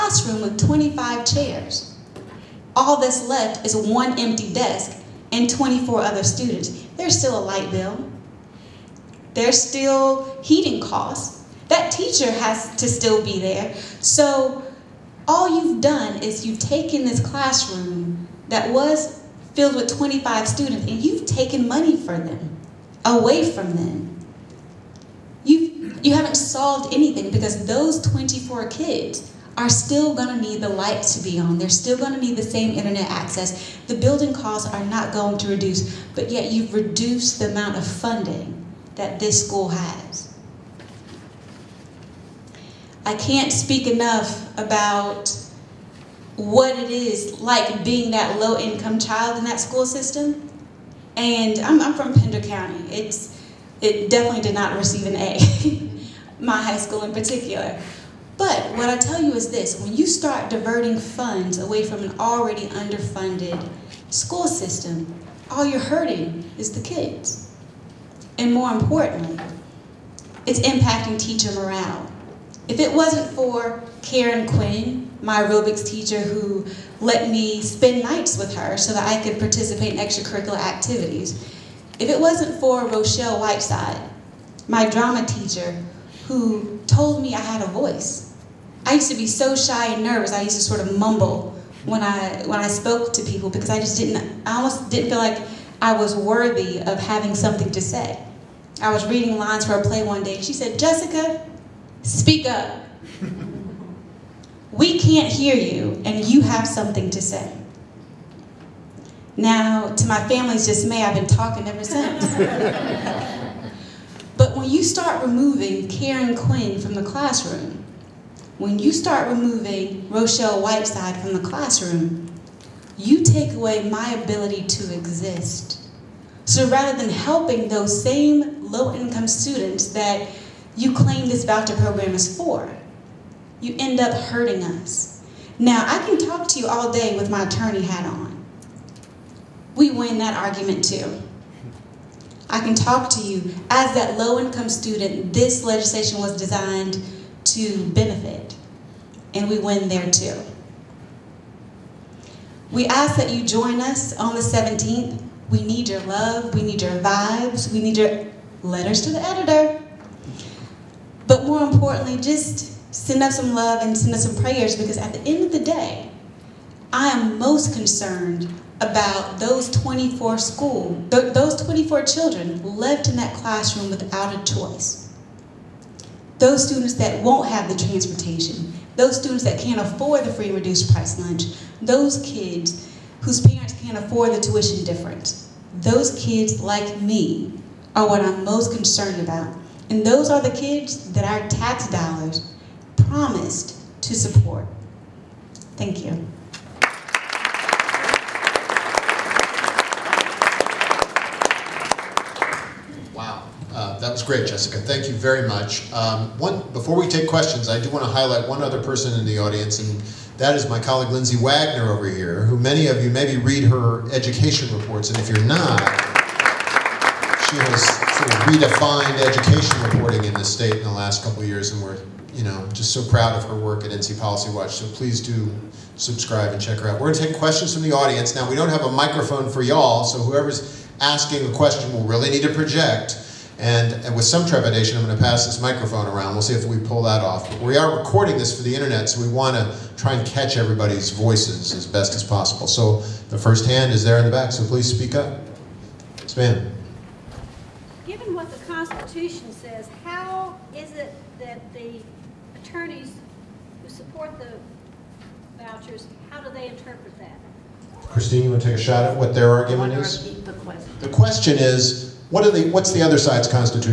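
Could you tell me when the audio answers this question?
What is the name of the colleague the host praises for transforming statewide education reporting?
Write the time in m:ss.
3:31.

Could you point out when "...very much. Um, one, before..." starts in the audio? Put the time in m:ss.
3:25.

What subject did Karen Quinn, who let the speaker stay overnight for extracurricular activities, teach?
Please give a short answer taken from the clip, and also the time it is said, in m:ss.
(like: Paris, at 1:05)
Aerobics, at 1:15.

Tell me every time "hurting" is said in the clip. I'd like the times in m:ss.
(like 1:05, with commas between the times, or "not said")
1:05, 2:14.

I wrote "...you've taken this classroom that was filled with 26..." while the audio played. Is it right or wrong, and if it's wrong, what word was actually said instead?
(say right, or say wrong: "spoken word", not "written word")
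wrong: "25", not "26".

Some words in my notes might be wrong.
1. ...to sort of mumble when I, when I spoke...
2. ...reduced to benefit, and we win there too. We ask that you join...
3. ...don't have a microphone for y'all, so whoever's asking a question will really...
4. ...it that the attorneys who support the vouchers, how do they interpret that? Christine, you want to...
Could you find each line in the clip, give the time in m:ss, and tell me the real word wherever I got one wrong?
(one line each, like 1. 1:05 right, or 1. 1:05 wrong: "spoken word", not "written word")
1. 1:30 right
2. 2:26 wrong: "designed", not "reduced"
3. 3:48 right
4. 4:10 right.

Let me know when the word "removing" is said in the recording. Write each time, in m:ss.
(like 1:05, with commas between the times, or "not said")
1:55, 1:59.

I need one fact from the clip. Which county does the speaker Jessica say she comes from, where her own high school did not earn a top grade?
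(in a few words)
Pender County.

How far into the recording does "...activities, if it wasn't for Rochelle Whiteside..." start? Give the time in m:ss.
1:20.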